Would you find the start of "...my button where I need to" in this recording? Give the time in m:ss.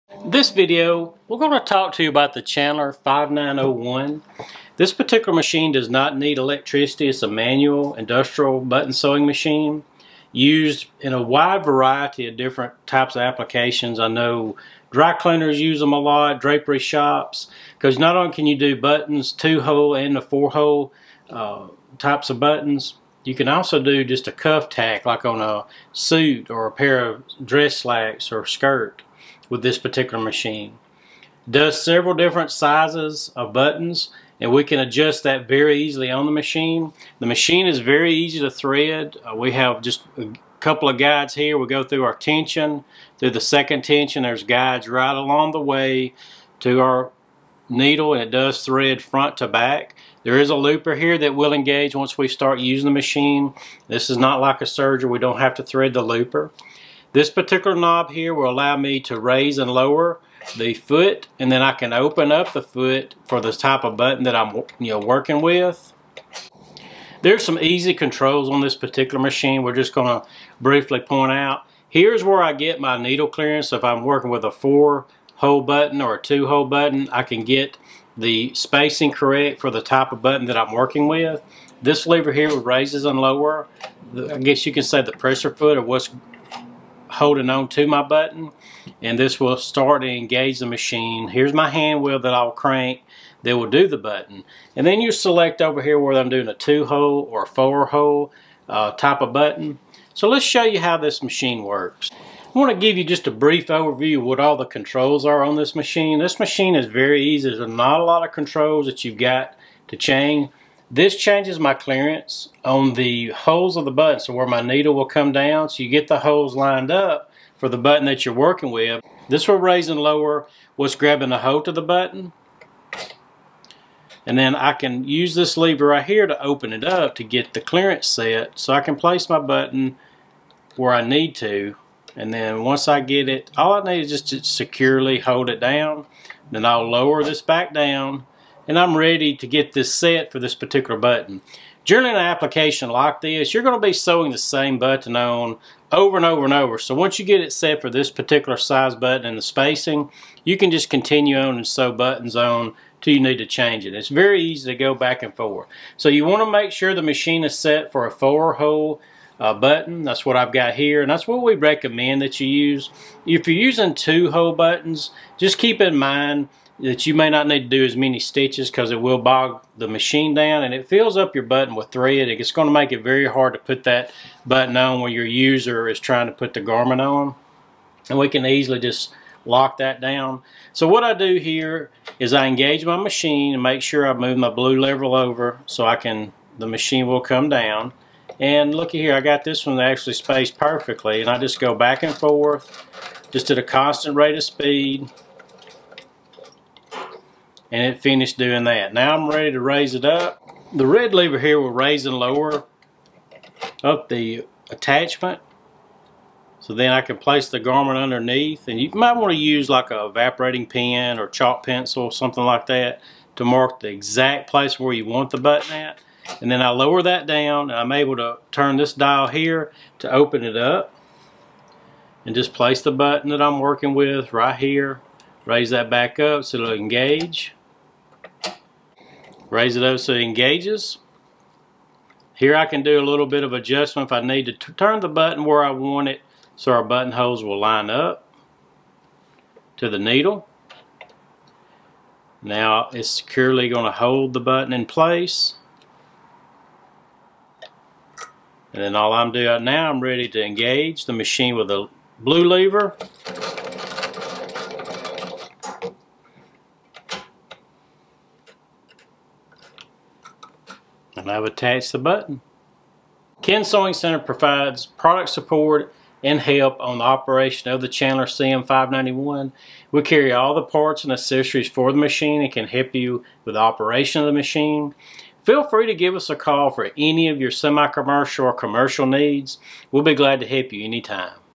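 2:09.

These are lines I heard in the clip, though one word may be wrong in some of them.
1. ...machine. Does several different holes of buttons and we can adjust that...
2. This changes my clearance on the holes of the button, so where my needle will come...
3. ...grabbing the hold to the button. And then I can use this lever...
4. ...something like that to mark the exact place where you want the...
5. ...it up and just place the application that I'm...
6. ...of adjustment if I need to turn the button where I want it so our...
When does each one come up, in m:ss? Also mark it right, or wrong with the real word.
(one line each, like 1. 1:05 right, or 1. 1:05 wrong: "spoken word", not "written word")
1. 0:30 wrong: "sizes", not "holes"
2. 1:50 right
3. 2:00 right
4. 3:32 right
5. 3:40 wrong: "button", not "application"
6. 3:53 right.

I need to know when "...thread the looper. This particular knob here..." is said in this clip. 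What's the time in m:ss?
0:55.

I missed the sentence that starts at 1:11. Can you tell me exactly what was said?
Here's where I get my needle clearance.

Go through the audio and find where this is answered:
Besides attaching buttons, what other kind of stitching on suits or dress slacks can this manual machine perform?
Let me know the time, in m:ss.
0:24.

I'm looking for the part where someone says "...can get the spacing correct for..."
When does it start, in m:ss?
1:17.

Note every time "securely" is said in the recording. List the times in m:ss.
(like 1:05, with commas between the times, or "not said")
2:14, 4:03.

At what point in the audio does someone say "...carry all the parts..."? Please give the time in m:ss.
4:30.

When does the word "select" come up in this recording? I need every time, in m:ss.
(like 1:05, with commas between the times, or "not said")
1:35.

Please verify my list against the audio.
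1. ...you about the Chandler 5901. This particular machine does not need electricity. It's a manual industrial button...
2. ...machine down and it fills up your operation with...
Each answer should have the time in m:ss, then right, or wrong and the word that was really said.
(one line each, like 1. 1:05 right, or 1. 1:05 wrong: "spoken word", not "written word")
1. 0:02 right
2. 2:49 wrong: "button", not "operation".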